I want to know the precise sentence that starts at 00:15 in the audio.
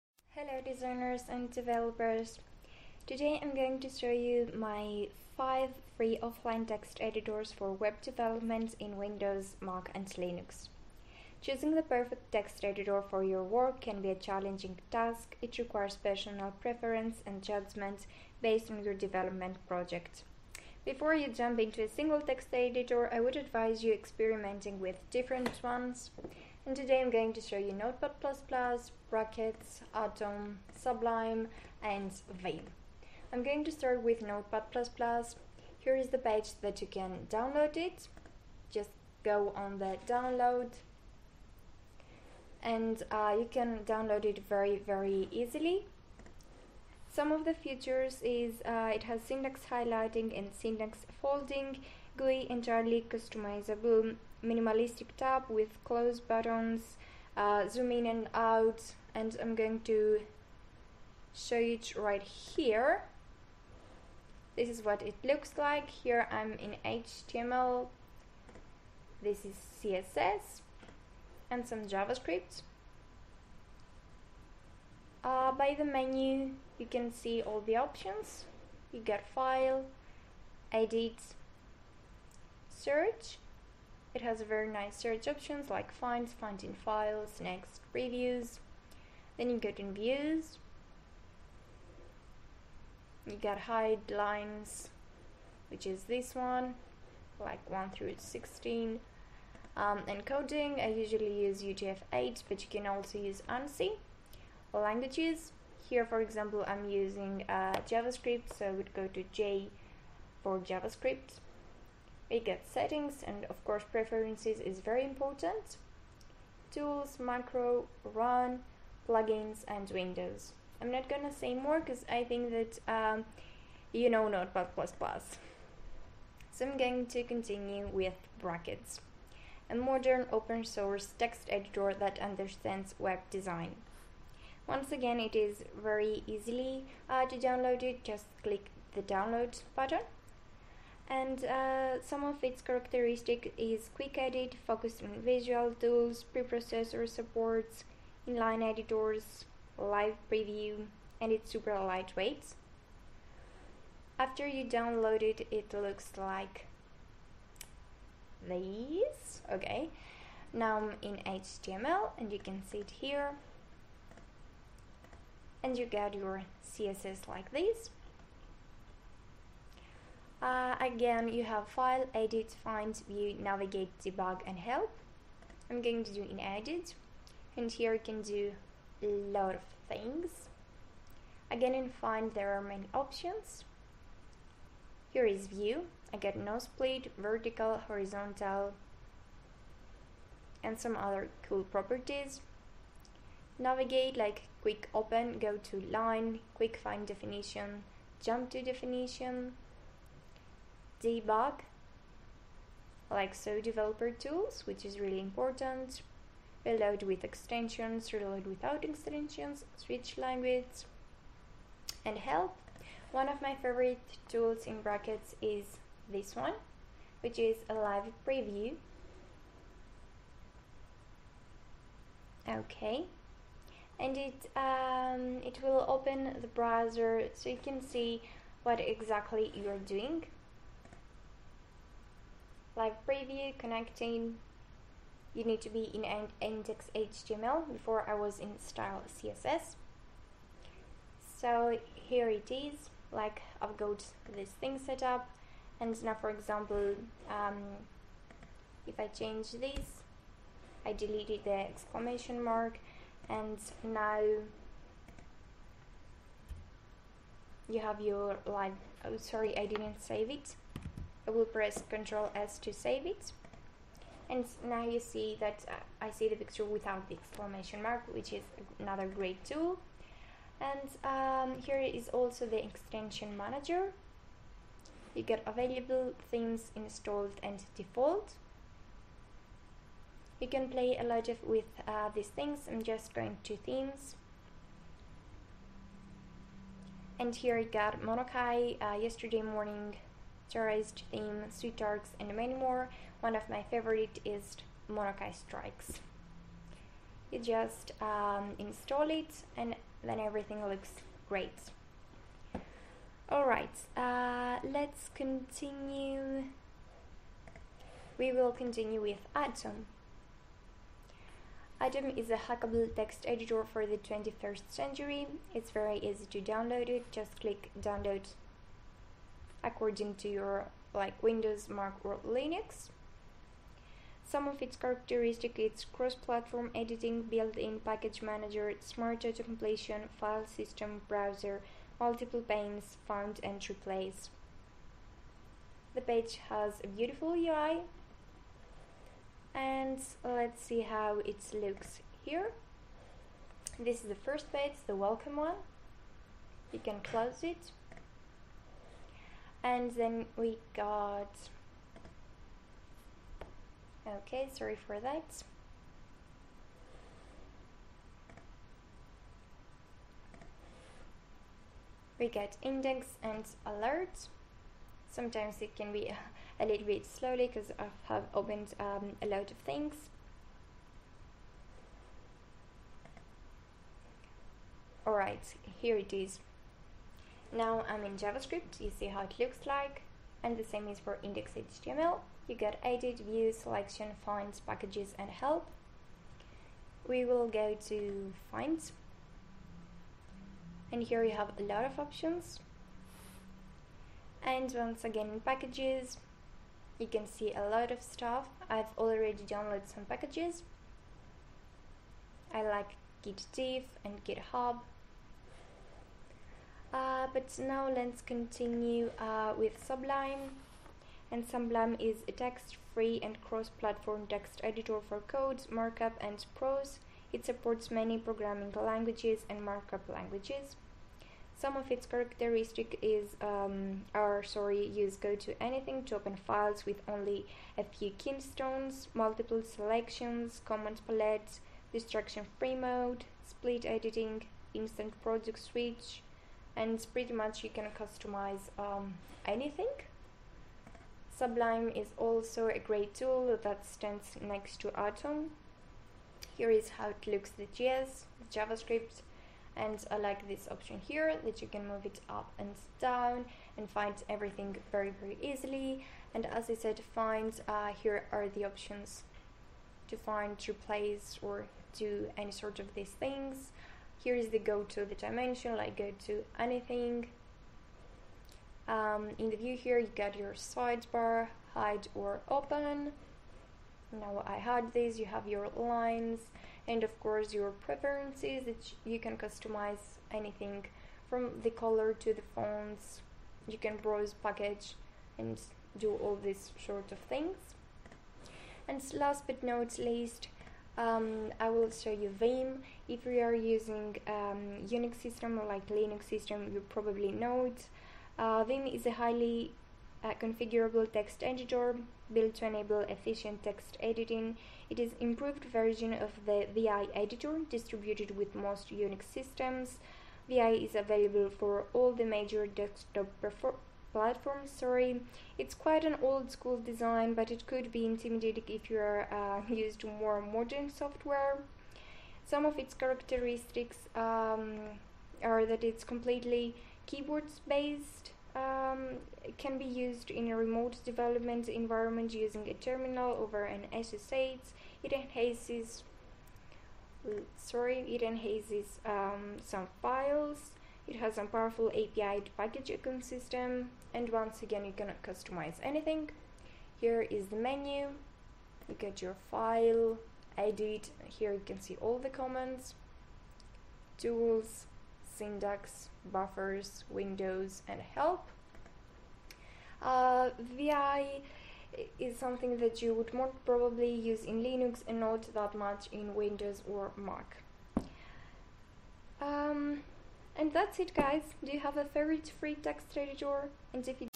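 It requires personal preference and judgment based on your development project.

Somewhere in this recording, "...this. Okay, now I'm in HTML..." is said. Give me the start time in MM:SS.
02:38.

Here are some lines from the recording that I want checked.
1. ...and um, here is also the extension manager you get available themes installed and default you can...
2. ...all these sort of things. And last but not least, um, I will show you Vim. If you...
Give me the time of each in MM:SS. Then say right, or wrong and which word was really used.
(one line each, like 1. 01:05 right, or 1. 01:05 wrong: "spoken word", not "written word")
1. 04:30 right
2. 08:06 right.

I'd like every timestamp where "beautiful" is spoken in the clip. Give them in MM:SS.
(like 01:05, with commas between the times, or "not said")
05:36.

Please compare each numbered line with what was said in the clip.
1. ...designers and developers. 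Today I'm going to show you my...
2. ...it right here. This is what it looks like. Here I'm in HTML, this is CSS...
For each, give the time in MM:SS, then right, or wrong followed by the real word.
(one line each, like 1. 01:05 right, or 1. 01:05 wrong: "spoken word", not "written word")
1. 00:00 right
2. 01:01 right.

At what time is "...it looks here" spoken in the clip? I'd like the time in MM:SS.
05:41.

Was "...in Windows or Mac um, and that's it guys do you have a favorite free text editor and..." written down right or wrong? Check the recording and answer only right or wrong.
right.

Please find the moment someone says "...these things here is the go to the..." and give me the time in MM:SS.
07:42.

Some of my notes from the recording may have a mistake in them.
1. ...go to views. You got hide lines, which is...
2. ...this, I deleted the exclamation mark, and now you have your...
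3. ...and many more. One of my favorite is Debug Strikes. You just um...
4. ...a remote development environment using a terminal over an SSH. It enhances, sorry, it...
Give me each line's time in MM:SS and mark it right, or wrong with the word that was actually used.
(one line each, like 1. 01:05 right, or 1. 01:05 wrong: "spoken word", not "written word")
1. 01:29 right
2. 04:09 right
3. 04:52 wrong: "Monokai", not "Debug"
4. 08:50 right.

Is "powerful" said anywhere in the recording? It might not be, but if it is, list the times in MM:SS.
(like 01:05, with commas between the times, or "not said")
09:01.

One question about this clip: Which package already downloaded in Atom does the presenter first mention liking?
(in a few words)
Git diff.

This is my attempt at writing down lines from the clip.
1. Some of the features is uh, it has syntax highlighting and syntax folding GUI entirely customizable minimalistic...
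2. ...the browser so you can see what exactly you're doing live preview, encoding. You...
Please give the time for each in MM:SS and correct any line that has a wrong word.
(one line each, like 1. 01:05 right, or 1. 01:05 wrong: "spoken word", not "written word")
1. 00:47 right
2. 03:46 wrong: "connecting", not "encoding".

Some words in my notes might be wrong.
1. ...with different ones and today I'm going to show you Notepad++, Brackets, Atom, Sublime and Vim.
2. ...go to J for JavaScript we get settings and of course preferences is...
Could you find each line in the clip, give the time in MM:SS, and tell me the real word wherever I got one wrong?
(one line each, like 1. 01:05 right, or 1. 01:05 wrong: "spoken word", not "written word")
1. 00:24 right
2. 01:48 right.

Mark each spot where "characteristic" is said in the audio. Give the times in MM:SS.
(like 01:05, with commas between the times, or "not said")
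02:22, 05:24, 07:02, 08:42.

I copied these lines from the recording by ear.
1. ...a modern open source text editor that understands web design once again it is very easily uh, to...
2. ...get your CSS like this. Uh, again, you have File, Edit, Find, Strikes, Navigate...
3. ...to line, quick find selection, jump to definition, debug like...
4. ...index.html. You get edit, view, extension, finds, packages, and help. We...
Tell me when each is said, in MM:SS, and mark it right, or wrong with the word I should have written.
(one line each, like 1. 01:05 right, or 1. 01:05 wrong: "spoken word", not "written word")
1. 02:09 right
2. 02:45 wrong: "View", not "Strikes"
3. 03:15 wrong: "definition", not "selection"
4. 06:21 wrong: "selection", not "extension".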